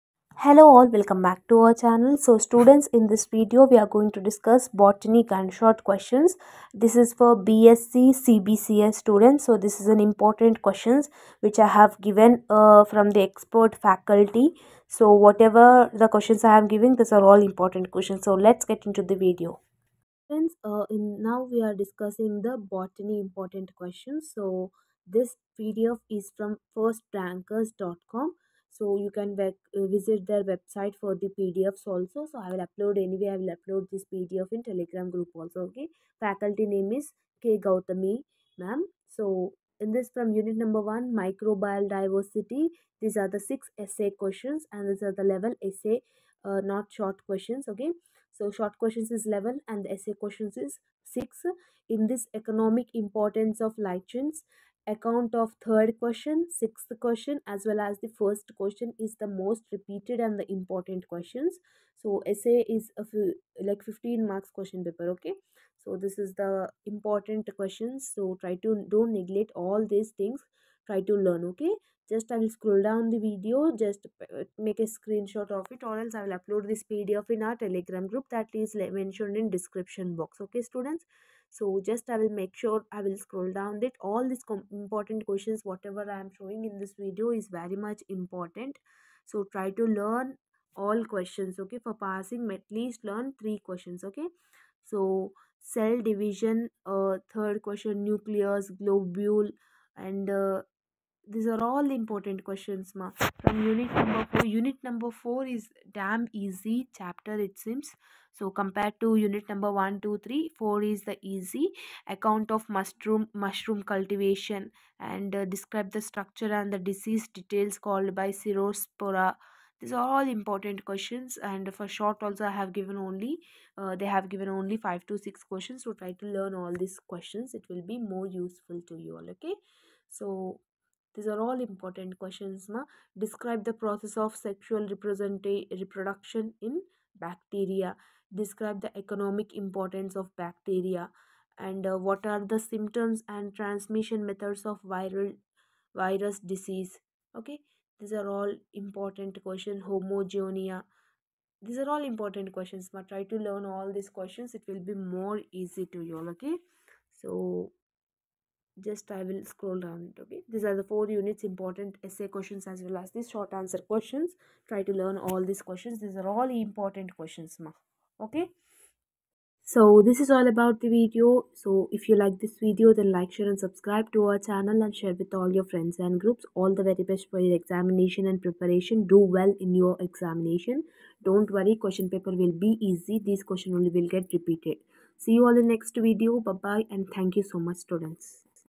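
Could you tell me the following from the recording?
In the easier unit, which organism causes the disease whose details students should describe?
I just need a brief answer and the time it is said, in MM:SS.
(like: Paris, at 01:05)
Cercospora, at 01:58.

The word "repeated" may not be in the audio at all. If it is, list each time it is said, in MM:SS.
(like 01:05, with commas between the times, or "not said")
00:59, 03:04.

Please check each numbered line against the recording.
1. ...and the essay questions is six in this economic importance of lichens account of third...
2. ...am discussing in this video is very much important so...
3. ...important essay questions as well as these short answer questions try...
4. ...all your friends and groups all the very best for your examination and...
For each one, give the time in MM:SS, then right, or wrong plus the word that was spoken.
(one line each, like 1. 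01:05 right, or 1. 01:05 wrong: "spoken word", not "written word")
1. 00:49 right
2. 01:26 wrong: "showing", not "discussing"
3. 02:41 right
4. 02:55 right.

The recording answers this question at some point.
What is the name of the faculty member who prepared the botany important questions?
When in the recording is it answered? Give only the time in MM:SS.
00:37.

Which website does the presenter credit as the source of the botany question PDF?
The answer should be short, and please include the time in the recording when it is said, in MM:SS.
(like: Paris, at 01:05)
firstrankers.com, at 00:26.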